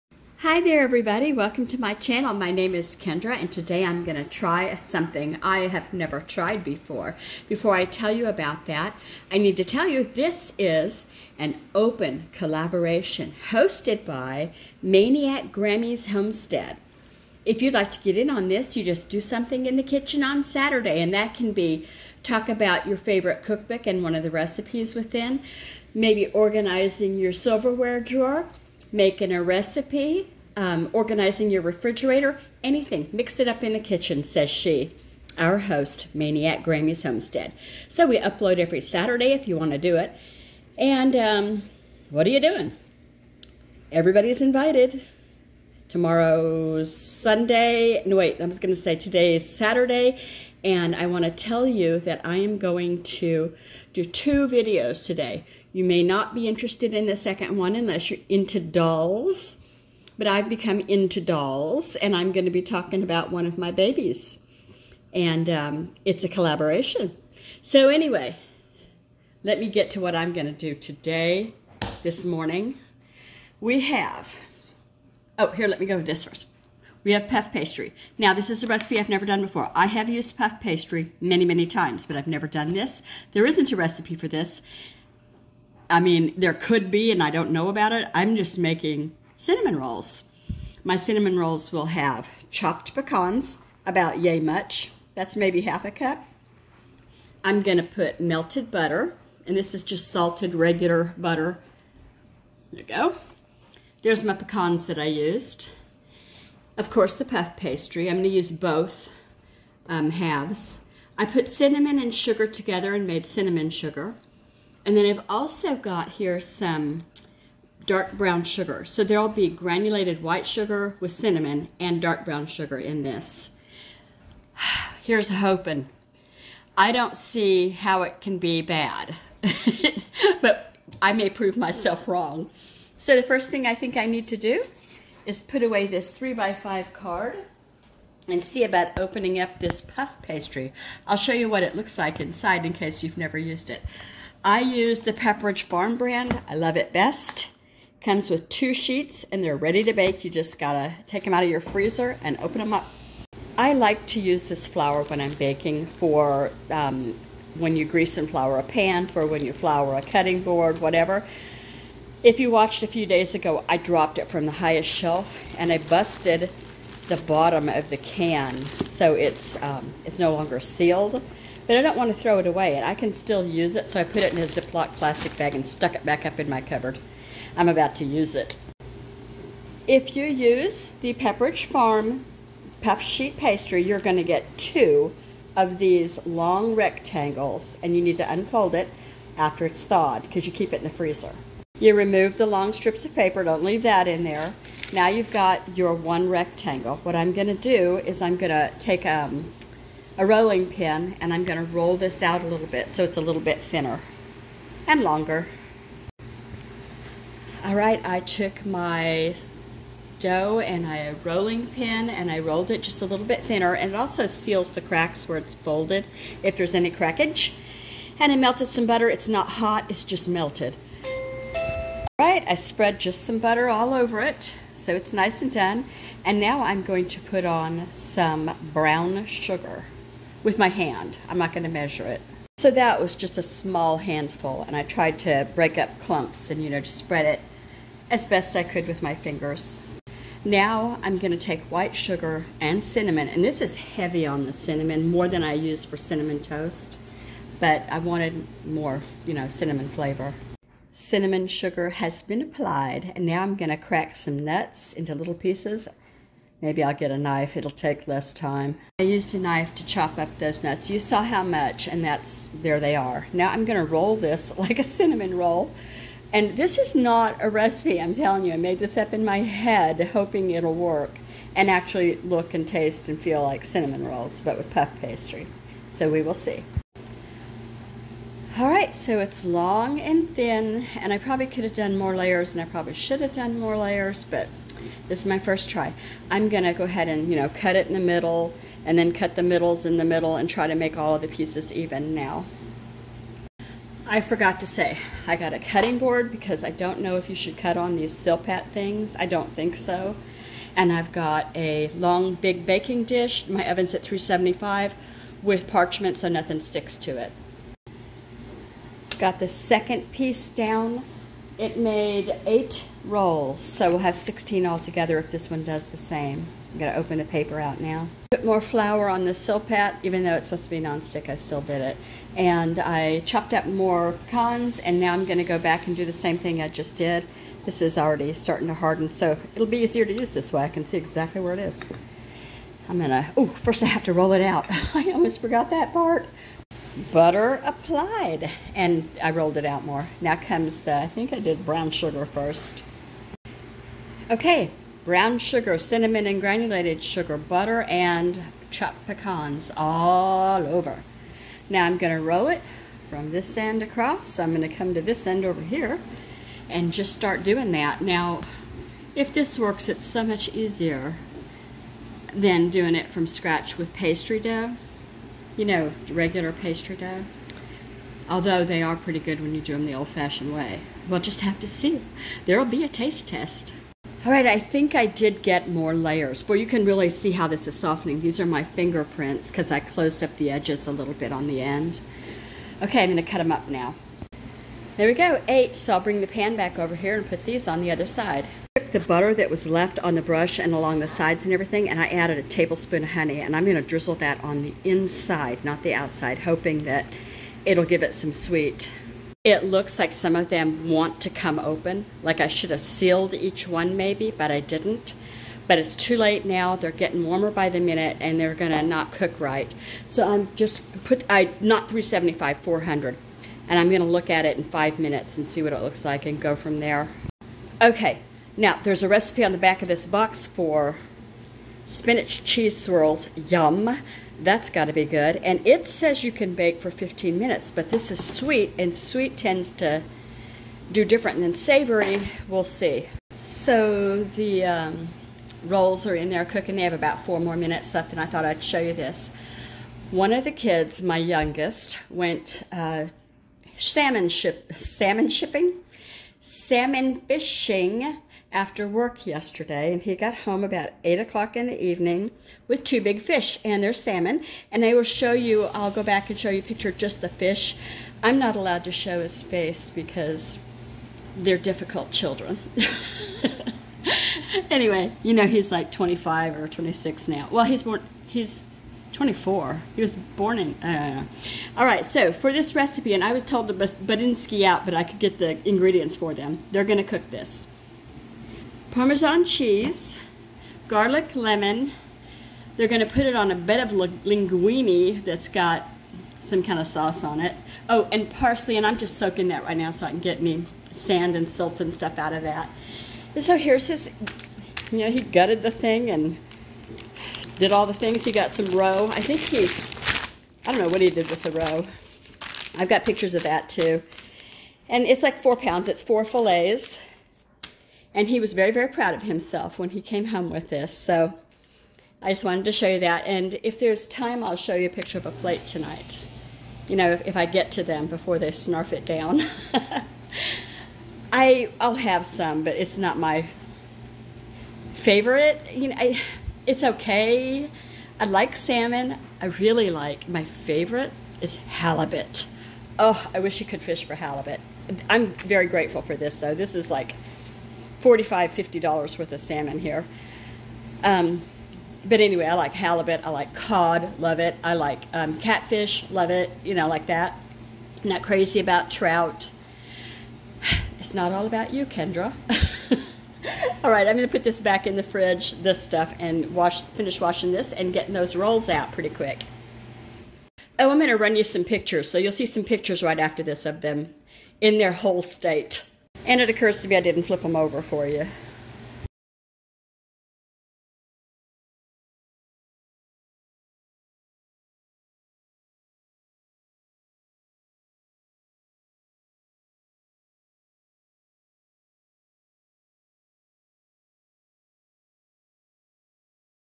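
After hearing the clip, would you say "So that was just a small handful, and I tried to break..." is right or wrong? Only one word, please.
right.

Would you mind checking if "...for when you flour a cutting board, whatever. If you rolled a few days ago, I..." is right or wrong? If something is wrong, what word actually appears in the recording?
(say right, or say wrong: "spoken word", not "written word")
wrong: "watched", not "rolled".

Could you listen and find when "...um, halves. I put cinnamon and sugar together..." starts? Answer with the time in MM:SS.
01:49.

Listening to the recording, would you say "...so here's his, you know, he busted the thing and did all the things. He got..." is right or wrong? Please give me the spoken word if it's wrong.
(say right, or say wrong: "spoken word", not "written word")
wrong: "gutted", not "busted".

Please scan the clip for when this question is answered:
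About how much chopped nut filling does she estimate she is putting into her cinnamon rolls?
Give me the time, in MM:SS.
01:35.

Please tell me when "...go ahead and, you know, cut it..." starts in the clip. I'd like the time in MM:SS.
04:46.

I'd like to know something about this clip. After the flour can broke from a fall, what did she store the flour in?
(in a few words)
Ziploc plastic bag.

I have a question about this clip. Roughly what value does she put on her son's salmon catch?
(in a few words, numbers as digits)
$45 to $50.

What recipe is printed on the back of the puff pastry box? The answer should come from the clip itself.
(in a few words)
spinach cheese swirls.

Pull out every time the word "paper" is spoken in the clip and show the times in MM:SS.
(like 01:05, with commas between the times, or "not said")
03:13, 05:17.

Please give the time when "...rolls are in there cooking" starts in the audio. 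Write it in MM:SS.
07:15.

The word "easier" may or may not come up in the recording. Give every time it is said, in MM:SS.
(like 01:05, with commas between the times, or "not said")
05:29, 06:00.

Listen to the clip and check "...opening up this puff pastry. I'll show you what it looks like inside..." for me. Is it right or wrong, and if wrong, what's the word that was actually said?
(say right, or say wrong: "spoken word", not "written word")
right.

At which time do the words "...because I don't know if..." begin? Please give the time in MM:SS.
04:56.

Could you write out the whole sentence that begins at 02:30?
You just gotta take them out of your freezer and open them up.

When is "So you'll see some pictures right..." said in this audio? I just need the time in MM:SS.
09:22.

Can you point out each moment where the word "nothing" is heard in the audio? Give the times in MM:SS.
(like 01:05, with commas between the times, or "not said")
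05:06.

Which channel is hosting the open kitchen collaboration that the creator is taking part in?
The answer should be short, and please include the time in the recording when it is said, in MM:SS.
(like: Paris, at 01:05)
MAINEiac Grammies Homestead, at 00:14.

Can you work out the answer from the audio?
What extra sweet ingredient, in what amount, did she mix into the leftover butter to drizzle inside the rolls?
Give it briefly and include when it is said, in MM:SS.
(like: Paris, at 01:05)
1 tablespoon of honey, at 06:32.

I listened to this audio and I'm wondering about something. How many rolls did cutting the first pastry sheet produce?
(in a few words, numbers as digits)
8.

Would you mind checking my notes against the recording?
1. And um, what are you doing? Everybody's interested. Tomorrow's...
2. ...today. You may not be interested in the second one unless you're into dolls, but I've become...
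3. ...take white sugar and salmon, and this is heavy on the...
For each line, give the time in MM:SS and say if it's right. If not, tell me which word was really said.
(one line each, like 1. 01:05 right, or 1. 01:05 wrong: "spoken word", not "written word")
1. 00:40 wrong: "invited", not "interested"
2. 00:55 right
3. 04:01 wrong: "cinnamon", not "salmon".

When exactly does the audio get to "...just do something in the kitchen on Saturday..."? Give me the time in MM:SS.
00:18.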